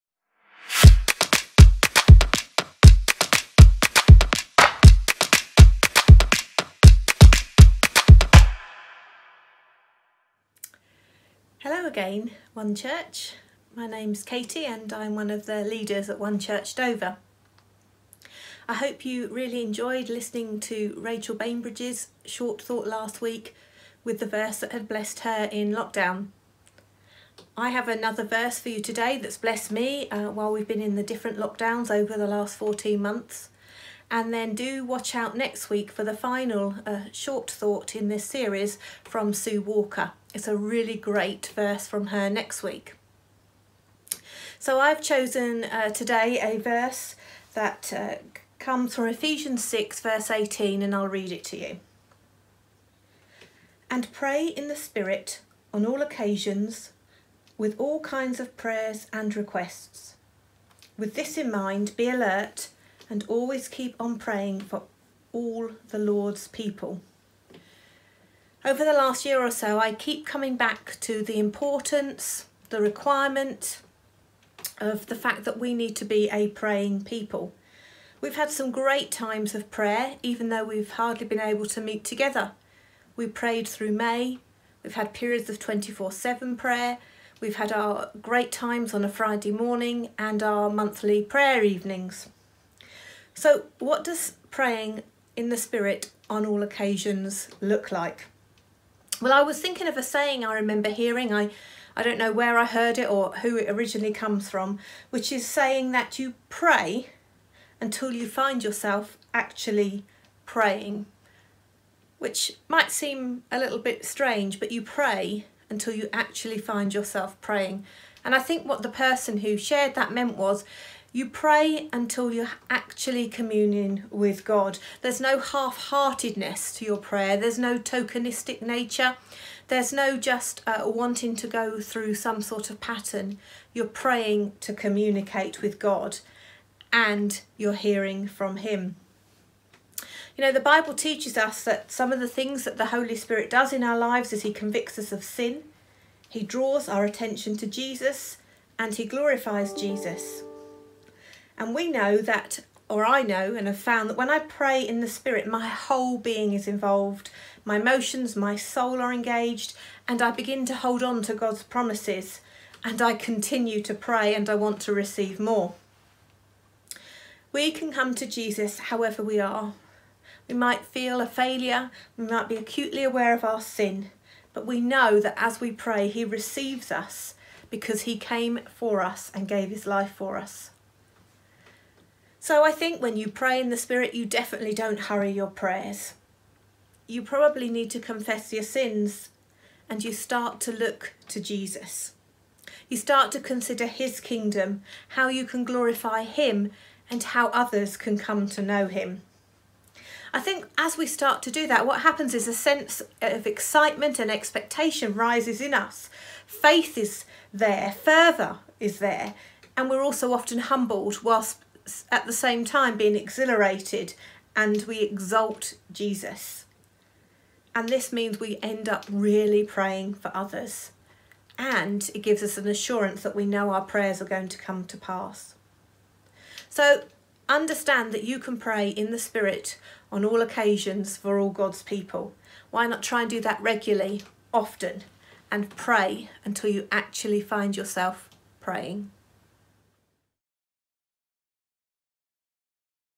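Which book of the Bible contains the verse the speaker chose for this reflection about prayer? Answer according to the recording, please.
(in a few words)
Ephesians.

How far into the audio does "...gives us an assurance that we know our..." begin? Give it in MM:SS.
03:42.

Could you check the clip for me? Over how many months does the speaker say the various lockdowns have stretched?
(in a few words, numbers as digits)
14.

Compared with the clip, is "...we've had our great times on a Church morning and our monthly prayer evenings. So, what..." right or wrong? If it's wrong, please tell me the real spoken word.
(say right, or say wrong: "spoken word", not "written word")
wrong: "Friday", not "Church".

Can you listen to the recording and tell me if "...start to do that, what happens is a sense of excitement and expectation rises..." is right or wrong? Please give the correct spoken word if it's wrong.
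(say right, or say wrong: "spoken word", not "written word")
right.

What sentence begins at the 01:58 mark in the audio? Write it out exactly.
And I think what the person who shared that meant was you pray until you're actually communing with God.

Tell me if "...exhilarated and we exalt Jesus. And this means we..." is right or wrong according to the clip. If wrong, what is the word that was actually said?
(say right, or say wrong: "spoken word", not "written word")
right.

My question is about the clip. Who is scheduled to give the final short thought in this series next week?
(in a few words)
Sue Walker.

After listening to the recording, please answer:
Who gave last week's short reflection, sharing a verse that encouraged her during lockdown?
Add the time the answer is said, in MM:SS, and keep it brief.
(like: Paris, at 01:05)
Rachel Bainbridge, at 00:20.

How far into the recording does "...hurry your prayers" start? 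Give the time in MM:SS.
03:04.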